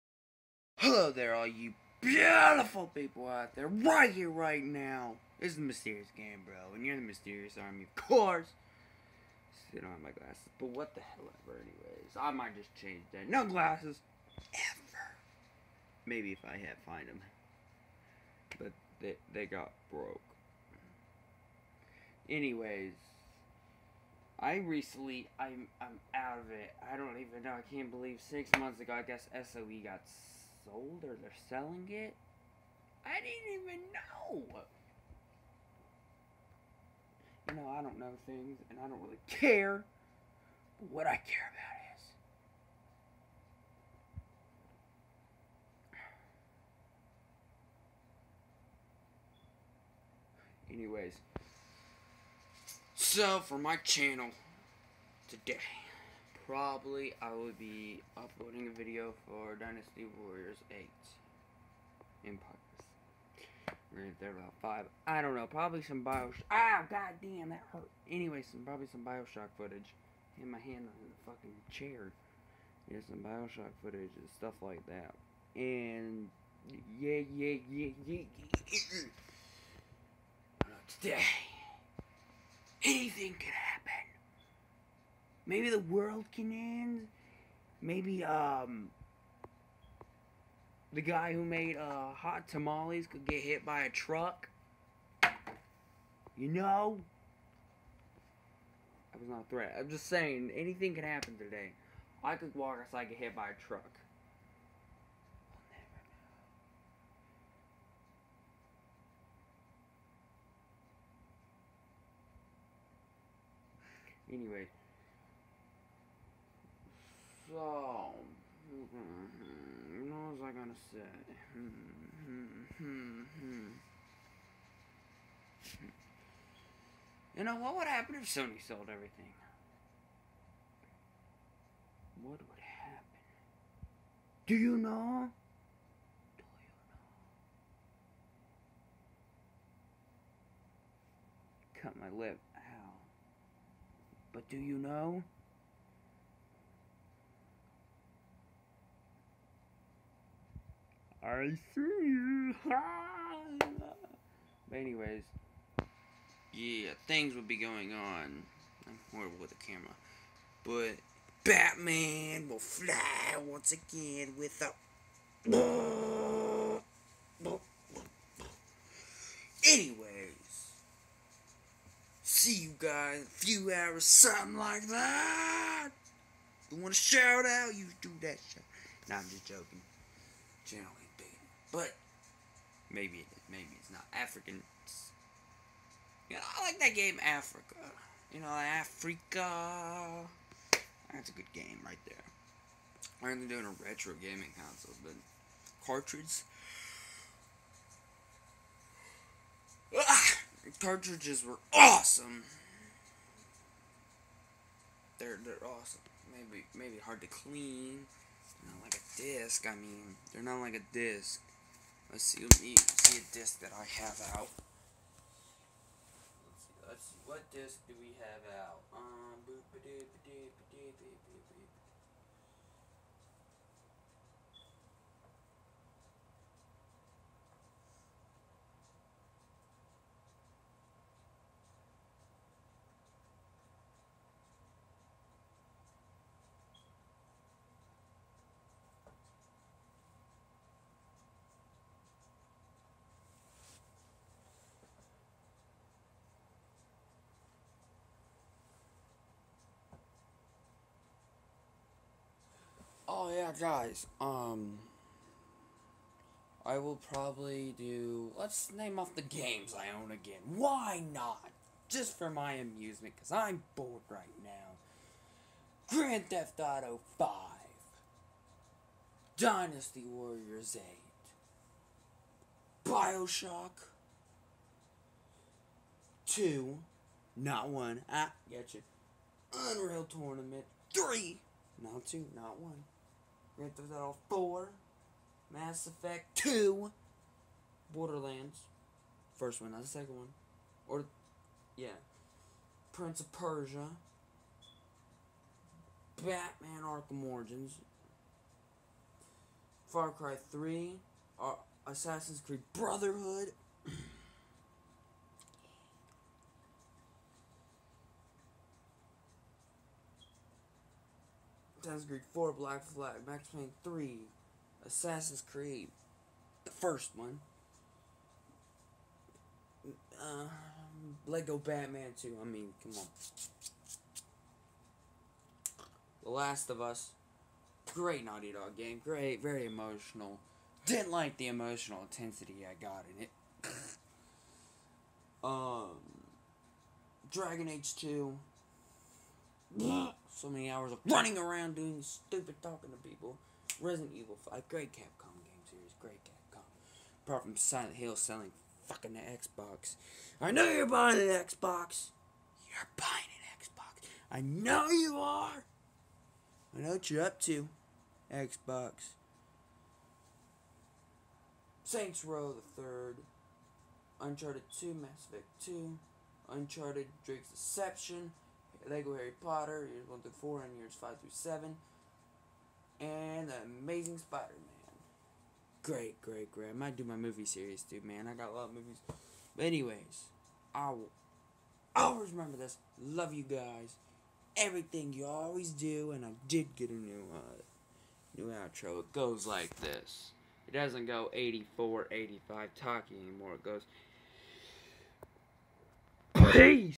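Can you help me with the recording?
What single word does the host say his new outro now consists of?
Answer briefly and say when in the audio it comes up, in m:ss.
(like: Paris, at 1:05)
Peace, at 6:36.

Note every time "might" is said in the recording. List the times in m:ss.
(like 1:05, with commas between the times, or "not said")
0:12, 6:16.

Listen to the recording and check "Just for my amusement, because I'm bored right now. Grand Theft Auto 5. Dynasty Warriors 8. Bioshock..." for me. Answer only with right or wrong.
right.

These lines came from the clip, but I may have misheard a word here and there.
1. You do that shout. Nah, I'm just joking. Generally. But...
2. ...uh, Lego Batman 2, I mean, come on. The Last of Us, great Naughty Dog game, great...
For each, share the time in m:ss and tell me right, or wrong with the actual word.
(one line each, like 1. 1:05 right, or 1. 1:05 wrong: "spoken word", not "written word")
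1. 2:57 right
2. 5:20 right.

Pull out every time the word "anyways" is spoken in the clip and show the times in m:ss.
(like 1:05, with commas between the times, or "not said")
0:11, 0:22, 0:50, 1:08, 1:54, 2:34, 2:49, 6:19.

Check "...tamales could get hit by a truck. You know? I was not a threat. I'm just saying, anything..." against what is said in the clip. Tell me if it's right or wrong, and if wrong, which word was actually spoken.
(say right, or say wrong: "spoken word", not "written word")
right.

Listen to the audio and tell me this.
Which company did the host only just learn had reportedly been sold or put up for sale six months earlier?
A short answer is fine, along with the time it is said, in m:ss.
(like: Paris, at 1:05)
SOE, at 0:29.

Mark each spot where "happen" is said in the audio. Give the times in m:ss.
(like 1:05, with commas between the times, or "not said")
1:23, 1:41, 2:07, 2:12.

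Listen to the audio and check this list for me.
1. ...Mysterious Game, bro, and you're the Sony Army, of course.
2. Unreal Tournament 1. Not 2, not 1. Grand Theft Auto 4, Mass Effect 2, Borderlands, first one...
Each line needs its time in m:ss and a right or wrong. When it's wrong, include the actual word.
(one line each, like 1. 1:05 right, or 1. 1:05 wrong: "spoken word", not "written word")
1. 0:05 wrong: "Mysterious", not "Sony"
2. 4:39 wrong: "3", not "1".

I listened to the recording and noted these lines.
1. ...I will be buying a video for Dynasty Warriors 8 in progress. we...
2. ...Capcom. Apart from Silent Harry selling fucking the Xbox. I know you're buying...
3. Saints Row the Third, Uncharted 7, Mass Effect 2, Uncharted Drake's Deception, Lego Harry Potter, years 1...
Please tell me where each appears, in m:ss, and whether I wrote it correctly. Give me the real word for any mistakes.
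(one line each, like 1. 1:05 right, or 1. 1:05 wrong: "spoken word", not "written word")
1. 0:57 wrong: "uploading", not "buying"
2. 5:46 wrong: "Hill", not "Harry"
3. 6:01 wrong: "2", not "7".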